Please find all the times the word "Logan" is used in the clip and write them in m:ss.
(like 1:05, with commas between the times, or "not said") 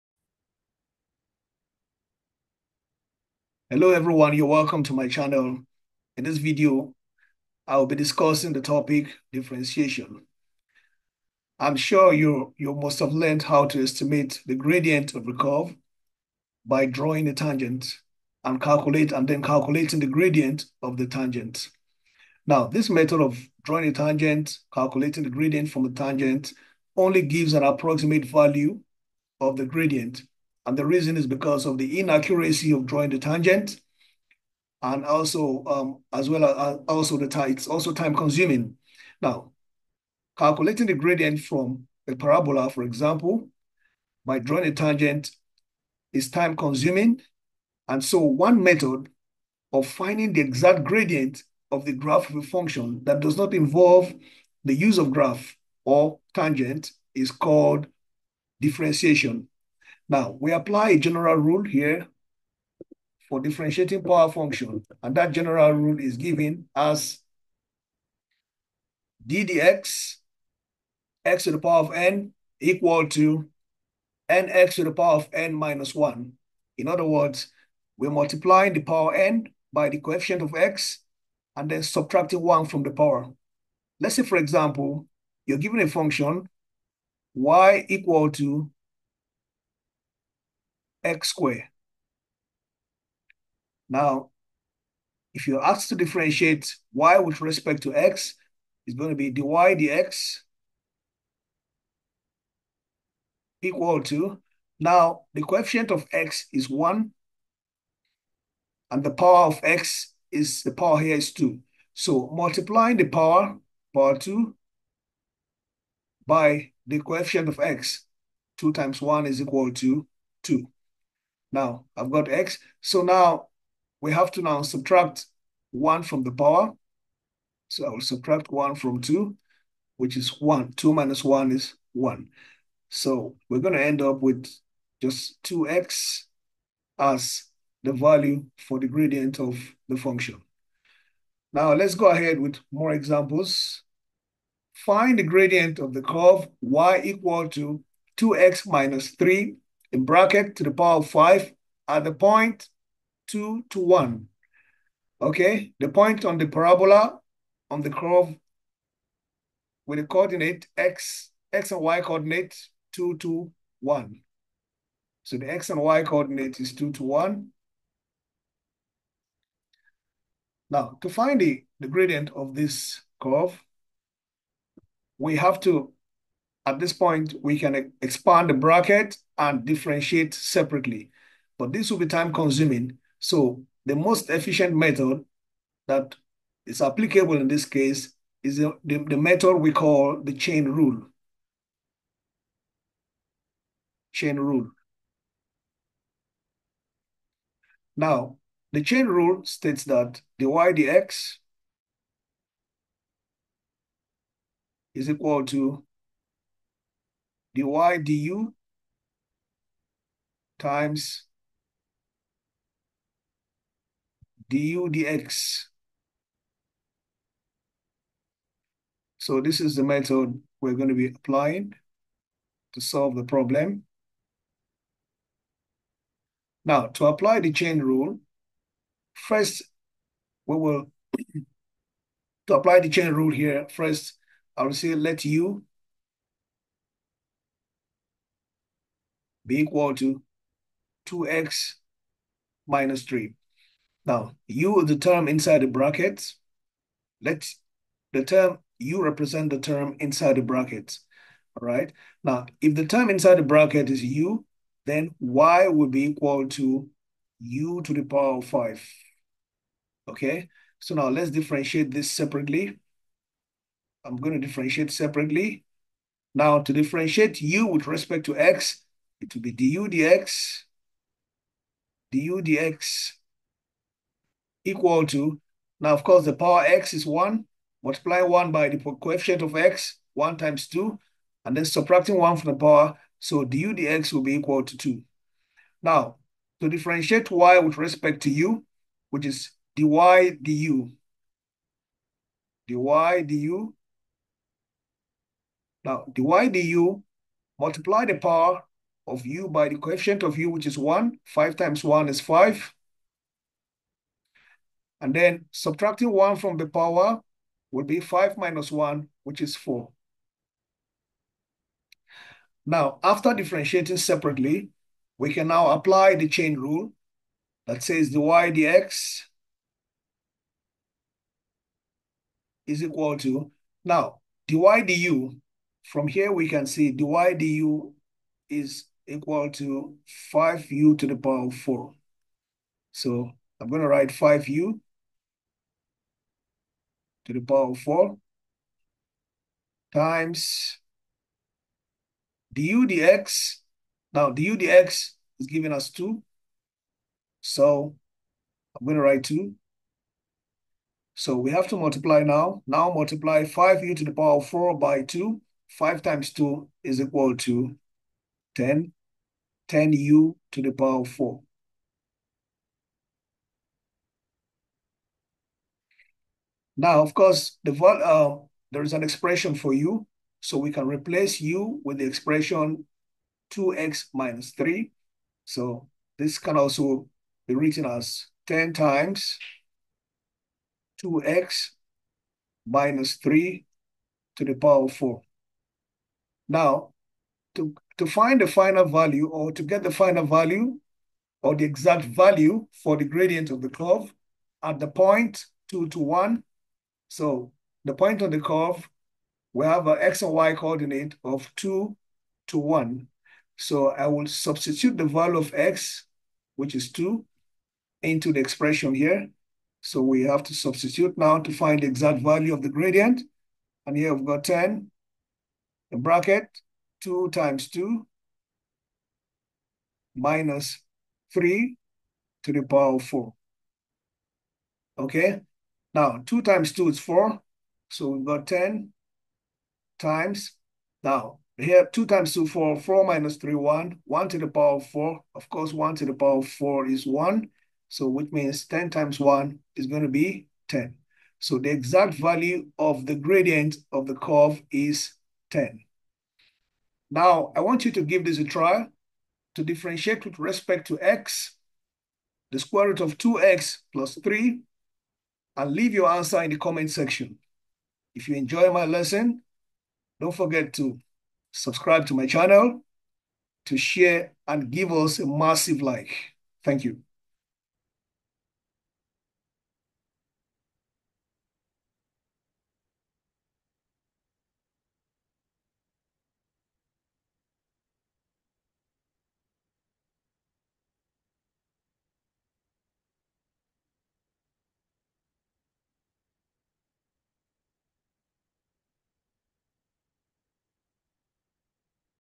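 not said.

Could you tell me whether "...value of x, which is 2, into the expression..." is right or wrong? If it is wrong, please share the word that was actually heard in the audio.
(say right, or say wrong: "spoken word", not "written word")
right.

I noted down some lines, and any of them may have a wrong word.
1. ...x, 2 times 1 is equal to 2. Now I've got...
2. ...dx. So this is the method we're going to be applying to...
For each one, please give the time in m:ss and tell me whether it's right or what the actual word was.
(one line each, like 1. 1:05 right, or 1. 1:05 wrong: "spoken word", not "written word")
1. 1:57 right
2. 3:34 right.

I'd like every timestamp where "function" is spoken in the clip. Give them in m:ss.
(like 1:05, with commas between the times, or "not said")
0:52, 1:04, 1:25, 2:19.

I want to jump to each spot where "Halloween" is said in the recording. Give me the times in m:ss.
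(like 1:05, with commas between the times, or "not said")
not said.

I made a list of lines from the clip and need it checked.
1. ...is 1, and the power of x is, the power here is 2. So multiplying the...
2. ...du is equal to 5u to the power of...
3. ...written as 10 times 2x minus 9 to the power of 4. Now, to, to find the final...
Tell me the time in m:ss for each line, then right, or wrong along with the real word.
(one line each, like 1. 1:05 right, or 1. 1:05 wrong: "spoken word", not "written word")
1. 1:46 right
2. 5:27 right
3. 6:17 wrong: "3", not "9".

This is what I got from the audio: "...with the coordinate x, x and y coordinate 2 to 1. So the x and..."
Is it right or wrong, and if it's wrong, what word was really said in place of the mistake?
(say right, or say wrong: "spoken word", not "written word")
right.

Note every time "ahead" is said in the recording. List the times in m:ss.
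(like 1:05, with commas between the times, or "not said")
2:22.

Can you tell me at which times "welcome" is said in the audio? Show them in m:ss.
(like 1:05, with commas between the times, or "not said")
0:04.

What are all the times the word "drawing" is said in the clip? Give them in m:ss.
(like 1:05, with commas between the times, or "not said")
0:16, 0:23, 0:32, 0:44.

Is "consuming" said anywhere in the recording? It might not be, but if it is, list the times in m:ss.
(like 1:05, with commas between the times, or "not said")
0:38, 0:46, 3:02.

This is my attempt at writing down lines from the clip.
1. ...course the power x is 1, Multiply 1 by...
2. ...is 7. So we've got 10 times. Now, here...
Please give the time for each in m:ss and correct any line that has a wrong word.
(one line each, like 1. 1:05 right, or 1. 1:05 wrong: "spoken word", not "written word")
1. 4:36 right
2. 7:06 wrong: "4", not "7".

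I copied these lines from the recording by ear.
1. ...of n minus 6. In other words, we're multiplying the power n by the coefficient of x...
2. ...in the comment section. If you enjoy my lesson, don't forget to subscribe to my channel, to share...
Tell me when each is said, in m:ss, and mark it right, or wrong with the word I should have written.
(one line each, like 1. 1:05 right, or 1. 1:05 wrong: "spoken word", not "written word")
1. 1:15 wrong: "1", not "6"
2. 7:36 right.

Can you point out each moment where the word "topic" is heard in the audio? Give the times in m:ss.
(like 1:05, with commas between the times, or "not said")
0:08.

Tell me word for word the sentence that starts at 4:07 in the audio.
Let the term u represent the term inside the brackets.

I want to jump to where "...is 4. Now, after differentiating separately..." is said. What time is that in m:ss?
5:09.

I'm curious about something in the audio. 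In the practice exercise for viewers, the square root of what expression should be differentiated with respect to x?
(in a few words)
2x + 3.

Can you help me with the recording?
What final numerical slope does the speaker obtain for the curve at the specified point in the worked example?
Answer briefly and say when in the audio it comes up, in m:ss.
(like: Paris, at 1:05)
10, at 7:21.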